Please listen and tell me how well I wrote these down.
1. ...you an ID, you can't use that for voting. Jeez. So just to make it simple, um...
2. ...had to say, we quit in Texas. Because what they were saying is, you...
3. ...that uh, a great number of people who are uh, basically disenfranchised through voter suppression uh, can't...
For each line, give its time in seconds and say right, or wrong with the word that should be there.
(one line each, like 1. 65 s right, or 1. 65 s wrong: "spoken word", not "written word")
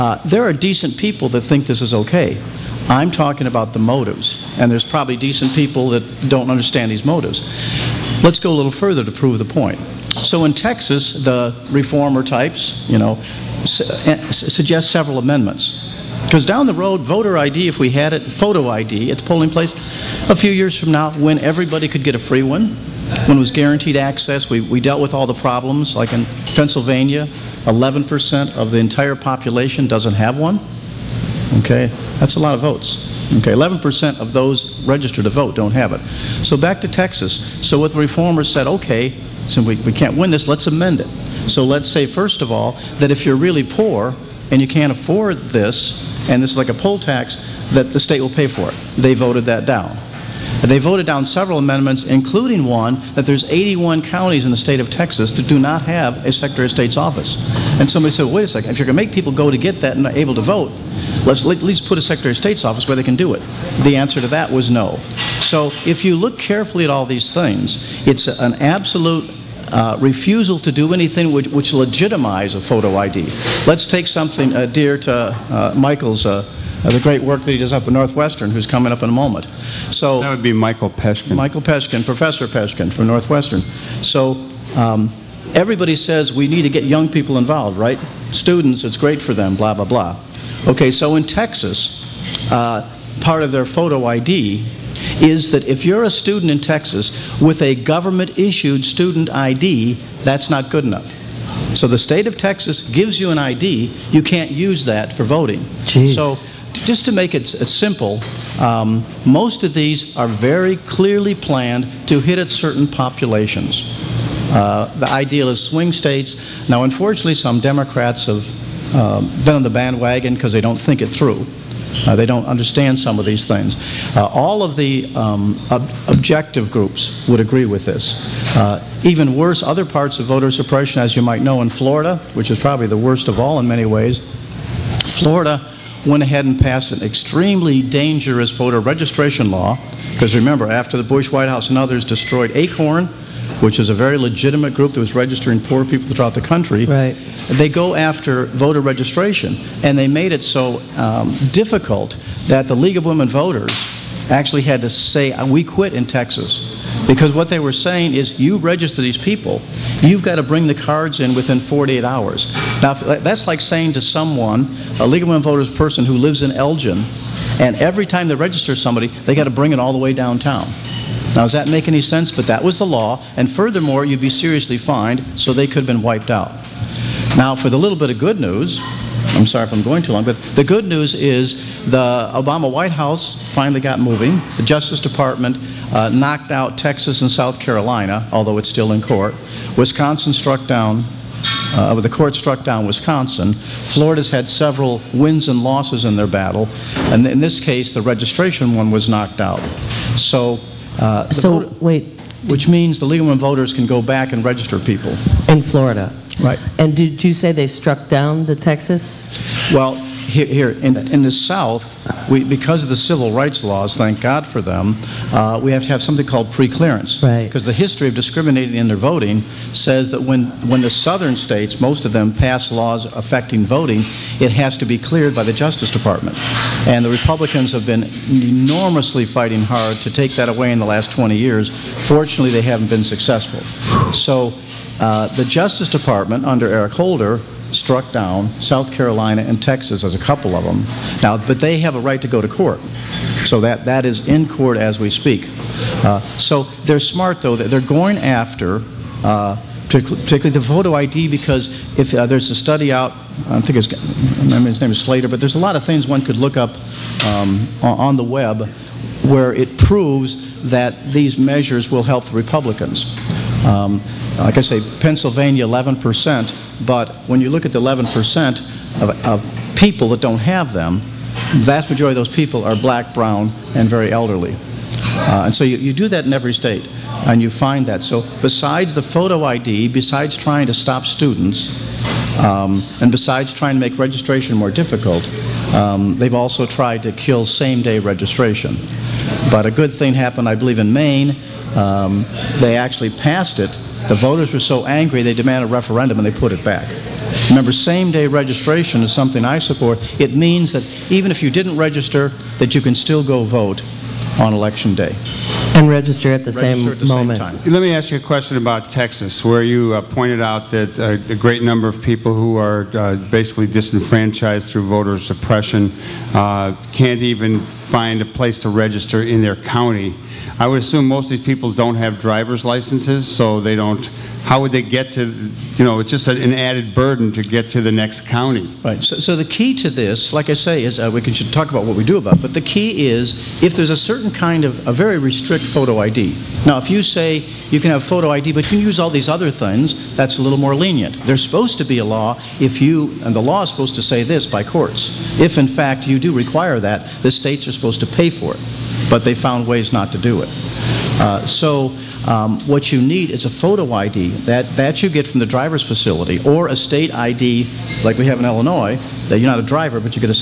1. 103 s right
2. 154 s right
3. 310 s right.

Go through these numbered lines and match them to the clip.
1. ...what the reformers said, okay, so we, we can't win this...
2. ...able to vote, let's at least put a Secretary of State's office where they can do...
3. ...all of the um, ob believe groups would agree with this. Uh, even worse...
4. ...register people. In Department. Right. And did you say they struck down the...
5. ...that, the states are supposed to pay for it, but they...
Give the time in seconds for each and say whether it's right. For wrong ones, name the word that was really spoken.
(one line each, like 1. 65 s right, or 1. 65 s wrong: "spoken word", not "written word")
1. 37 s right
2. 60 s right
3. 124 s wrong: "objective", not "believe"
4. 204 s wrong: "Florida", not "Department"
5. 346 s right.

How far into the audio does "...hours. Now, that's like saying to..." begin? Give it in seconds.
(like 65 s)
162 s.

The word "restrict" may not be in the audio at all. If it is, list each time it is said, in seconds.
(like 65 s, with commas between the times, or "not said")
335 s.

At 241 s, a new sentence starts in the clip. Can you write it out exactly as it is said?
Now, but they have a right to go to court.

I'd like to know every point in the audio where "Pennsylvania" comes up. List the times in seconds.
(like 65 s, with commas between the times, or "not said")
26 s, 265 s.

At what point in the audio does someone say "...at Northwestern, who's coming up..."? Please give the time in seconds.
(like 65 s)
77 s.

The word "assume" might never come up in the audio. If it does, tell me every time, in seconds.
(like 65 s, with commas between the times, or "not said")
320 s.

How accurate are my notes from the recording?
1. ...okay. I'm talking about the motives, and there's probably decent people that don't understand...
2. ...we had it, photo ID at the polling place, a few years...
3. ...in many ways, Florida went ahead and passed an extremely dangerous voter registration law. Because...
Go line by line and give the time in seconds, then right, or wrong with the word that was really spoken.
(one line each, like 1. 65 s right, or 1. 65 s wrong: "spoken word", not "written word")
1. 1 s right
2. 17 s right
3. 133 s right.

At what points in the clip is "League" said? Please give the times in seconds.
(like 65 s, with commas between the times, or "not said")
152 s, 165 s.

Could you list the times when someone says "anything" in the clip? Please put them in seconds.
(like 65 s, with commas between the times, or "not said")
70 s.